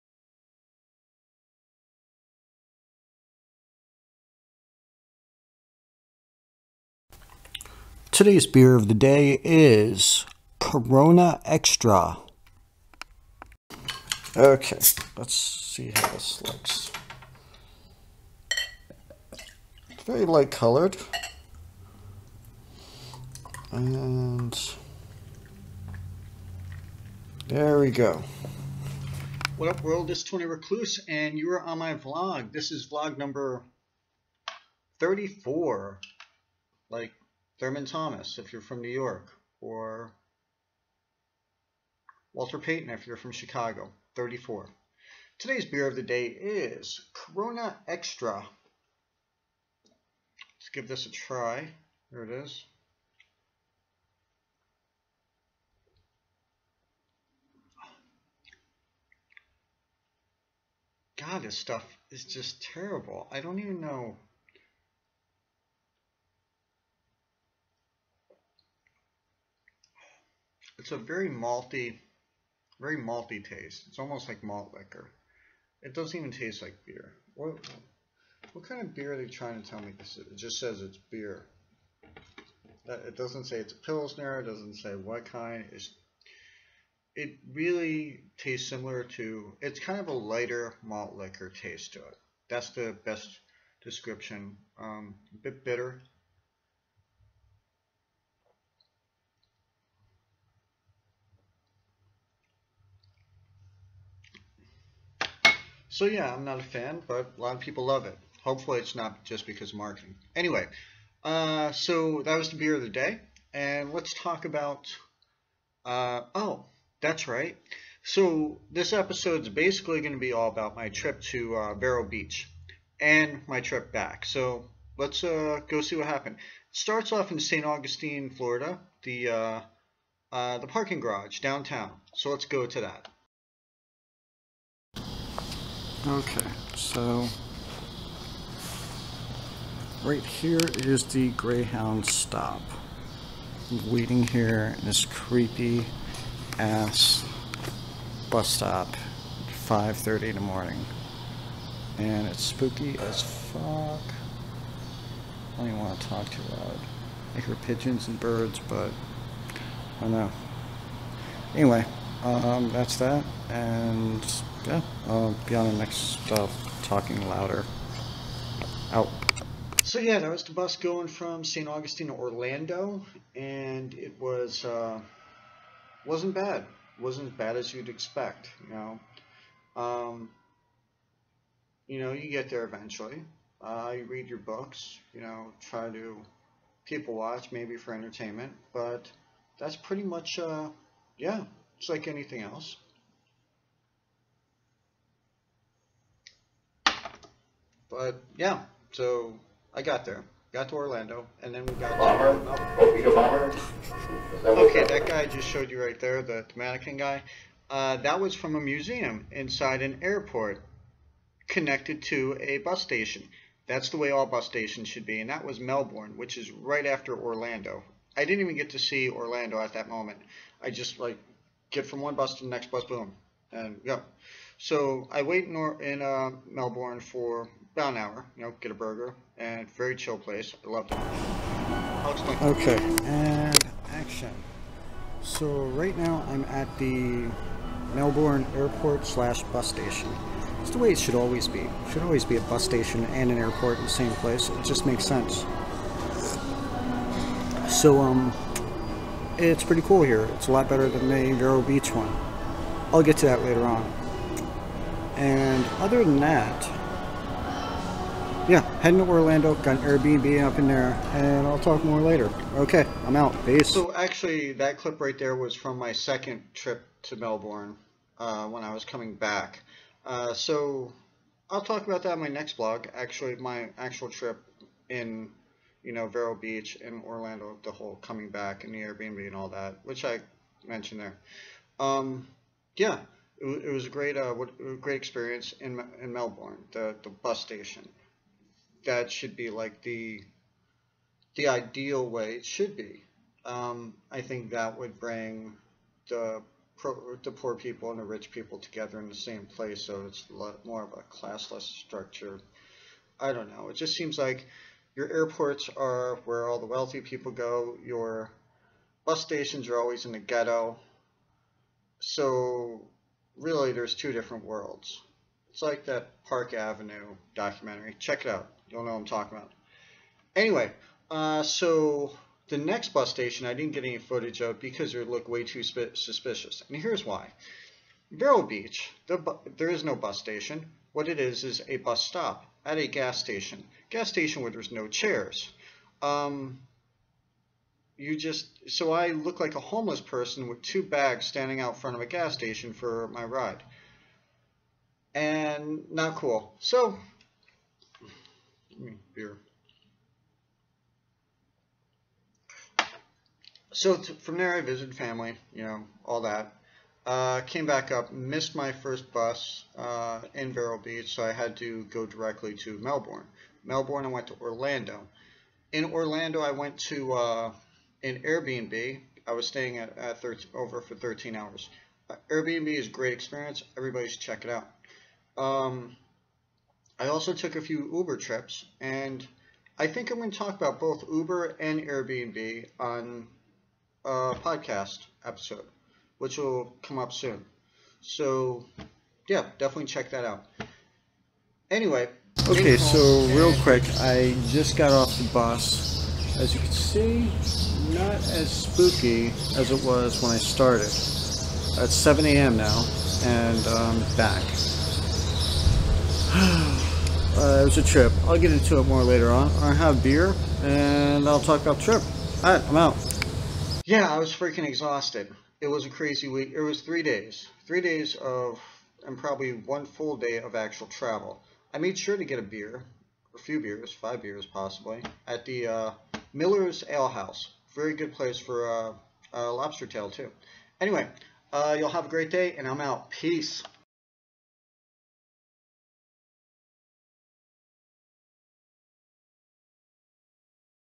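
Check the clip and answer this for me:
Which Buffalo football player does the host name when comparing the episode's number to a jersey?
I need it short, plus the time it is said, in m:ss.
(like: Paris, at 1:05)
Thurman Thomas, at 0:37.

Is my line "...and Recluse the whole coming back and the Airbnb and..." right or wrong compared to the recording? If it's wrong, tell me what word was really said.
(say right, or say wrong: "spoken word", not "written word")
wrong: "Orlando", not "Recluse".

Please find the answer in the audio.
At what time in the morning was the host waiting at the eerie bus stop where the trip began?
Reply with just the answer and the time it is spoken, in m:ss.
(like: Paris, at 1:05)
5:30, at 2:29.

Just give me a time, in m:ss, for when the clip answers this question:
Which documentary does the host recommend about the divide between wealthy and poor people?
5:16.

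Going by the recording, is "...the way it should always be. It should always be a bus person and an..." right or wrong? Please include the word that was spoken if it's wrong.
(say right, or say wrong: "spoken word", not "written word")
wrong: "station", not "person".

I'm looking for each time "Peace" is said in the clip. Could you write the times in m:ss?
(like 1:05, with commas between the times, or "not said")
4:23, 7:13.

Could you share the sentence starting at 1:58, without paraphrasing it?
So this episode's basically going to be all about my trip to uh, Vero Beach and my trip back.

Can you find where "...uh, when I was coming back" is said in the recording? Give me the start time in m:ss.
4:28.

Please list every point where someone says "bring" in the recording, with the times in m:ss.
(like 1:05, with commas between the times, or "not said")
4:54.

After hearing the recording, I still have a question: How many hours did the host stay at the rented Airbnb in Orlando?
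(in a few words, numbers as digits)
13.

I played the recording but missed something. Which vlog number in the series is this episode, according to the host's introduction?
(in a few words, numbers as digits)
34.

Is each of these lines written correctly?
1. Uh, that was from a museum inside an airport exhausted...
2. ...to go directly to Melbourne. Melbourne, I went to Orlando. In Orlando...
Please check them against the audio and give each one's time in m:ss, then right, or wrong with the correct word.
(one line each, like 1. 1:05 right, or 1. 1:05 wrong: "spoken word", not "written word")
1. 3:27 wrong: "connected", not "exhausted"
2. 6:01 right.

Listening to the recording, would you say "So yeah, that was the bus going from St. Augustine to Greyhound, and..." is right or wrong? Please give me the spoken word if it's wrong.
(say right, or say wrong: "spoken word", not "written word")
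wrong: "Orlando", not "Greyhound".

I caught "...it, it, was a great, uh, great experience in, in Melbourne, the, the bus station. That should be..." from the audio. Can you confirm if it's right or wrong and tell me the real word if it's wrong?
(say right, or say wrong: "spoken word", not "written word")
right.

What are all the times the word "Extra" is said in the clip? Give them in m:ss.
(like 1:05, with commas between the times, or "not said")
0:11, 0:47.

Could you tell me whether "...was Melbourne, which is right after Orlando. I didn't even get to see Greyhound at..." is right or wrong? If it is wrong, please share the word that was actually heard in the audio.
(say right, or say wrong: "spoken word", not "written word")
wrong: "Orlando", not "Greyhound".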